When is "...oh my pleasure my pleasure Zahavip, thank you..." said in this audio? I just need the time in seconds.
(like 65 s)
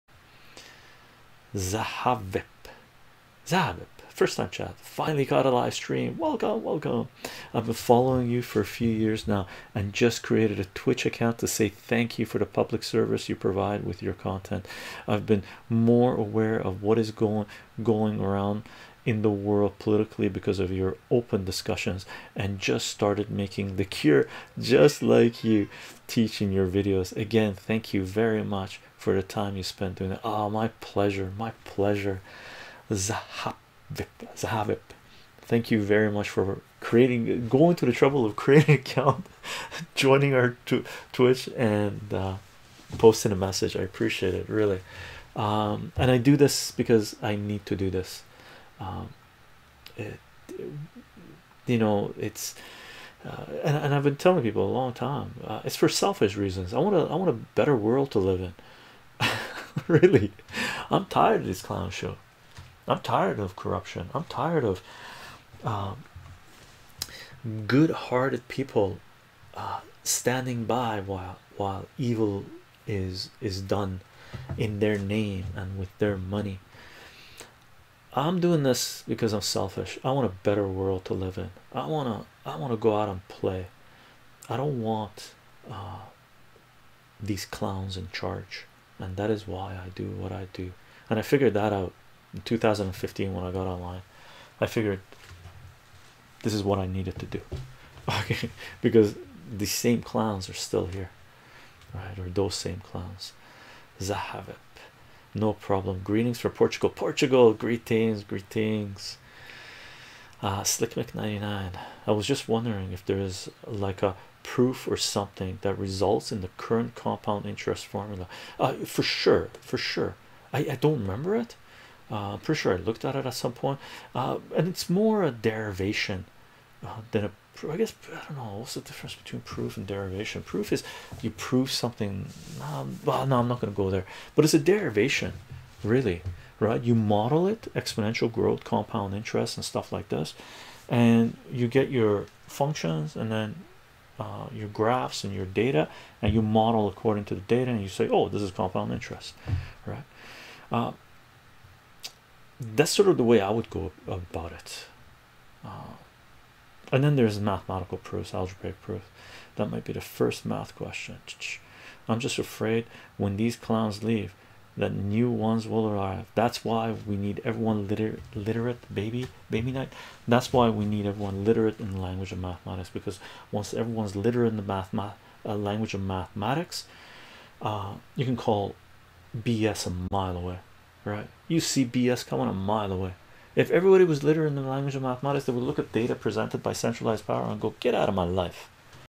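30 s.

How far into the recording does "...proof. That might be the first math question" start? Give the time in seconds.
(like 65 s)
158 s.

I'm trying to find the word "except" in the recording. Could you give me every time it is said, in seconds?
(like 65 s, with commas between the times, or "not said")
not said.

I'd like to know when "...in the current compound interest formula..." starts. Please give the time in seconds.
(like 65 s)
116 s.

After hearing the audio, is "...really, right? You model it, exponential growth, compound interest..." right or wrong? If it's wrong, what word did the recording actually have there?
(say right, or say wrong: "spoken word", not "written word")
right.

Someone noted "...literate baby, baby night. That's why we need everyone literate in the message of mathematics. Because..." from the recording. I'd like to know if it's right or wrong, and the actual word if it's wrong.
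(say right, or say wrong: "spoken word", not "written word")
wrong: "language", not "message".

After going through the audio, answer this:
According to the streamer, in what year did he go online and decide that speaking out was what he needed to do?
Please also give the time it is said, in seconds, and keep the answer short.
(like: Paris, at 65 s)
2015, at 92 s.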